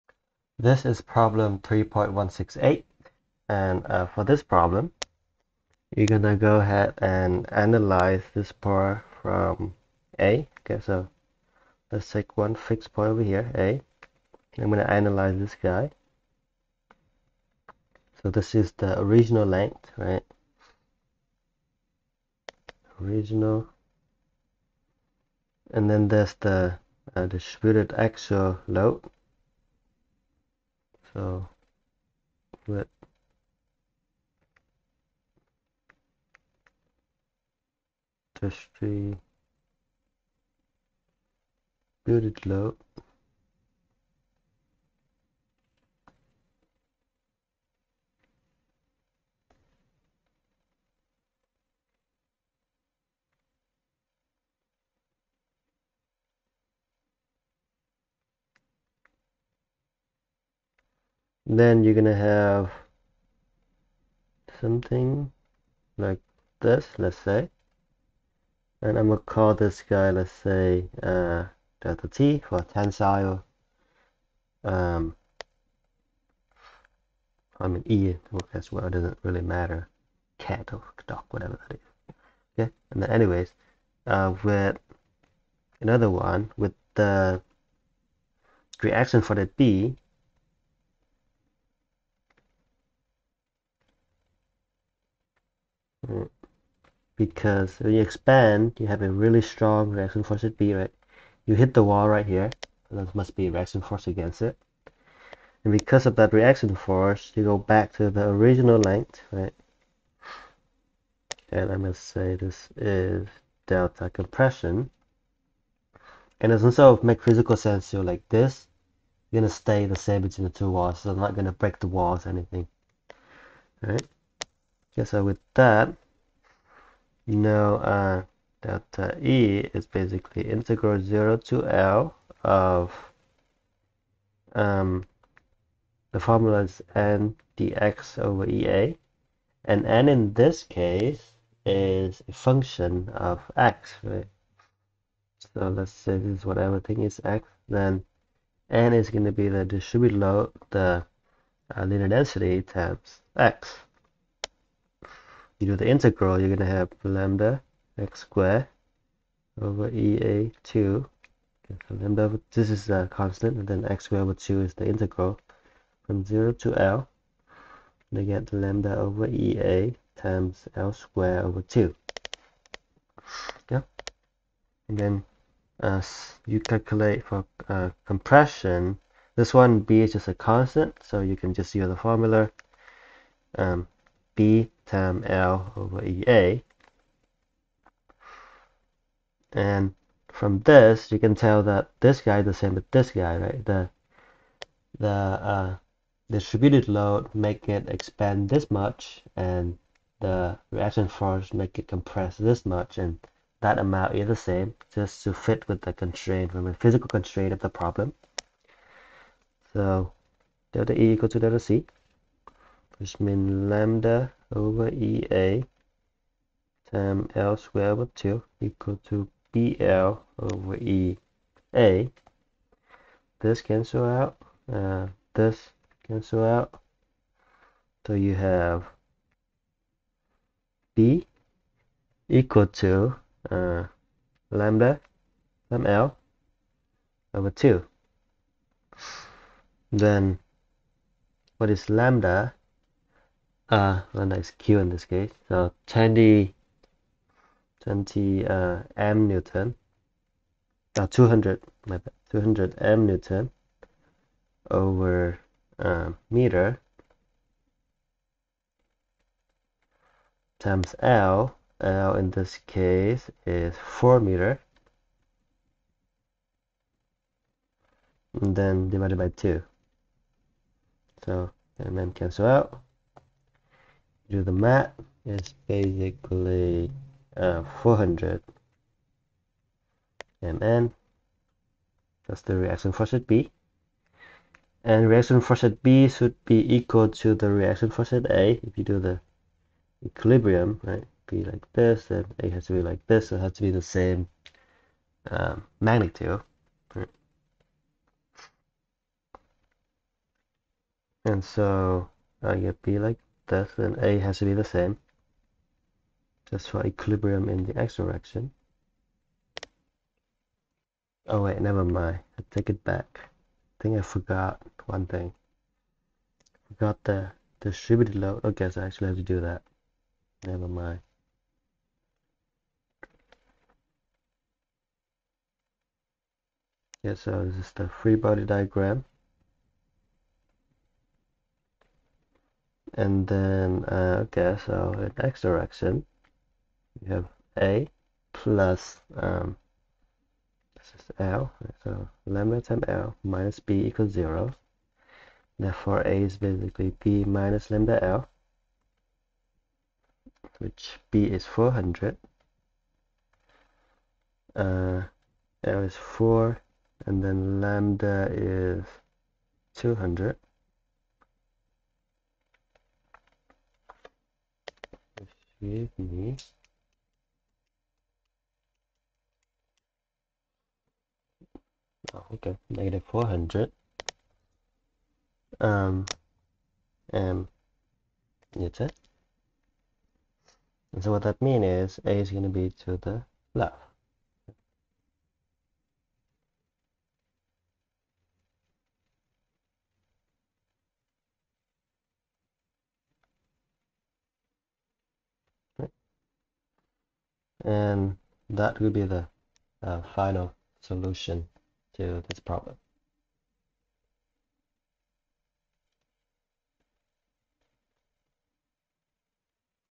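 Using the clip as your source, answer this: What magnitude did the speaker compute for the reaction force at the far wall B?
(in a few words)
400 mN.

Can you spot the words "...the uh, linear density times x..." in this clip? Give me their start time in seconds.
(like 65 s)
150 s.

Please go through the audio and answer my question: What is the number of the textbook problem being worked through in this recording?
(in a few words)
3.168.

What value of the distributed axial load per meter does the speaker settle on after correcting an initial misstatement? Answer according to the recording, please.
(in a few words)
200 mN/m.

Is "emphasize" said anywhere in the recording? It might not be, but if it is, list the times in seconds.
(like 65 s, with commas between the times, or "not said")
not said.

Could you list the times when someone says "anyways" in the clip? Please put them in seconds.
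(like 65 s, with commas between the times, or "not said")
83 s.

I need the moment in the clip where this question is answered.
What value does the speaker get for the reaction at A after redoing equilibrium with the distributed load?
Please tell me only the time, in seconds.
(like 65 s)
372 s.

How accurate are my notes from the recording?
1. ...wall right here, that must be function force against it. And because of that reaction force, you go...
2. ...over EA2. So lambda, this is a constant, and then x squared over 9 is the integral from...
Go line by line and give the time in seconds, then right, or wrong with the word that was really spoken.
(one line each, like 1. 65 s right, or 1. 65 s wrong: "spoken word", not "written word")
1. 101 s wrong: "reaction", not "function"
2. 159 s wrong: "2", not "9".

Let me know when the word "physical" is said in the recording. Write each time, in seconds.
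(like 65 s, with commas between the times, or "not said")
117 s, 206 s.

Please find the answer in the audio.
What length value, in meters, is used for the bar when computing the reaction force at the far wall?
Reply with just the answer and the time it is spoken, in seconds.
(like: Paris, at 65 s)
4 meters, at 263 s.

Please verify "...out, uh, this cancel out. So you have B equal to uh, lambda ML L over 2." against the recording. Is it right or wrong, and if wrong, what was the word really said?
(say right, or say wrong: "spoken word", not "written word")
right.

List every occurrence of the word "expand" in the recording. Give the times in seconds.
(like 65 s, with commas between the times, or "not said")
98 s, 197 s.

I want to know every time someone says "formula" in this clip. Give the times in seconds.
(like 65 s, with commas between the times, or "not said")
136 s, 181 s.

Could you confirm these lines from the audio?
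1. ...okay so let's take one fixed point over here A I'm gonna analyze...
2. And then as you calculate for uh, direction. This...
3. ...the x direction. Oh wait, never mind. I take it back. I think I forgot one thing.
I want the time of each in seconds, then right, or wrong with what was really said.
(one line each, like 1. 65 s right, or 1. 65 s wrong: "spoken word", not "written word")
1. 10 s right
2. 174 s wrong: "compression", not "direction"
3. 307 s right.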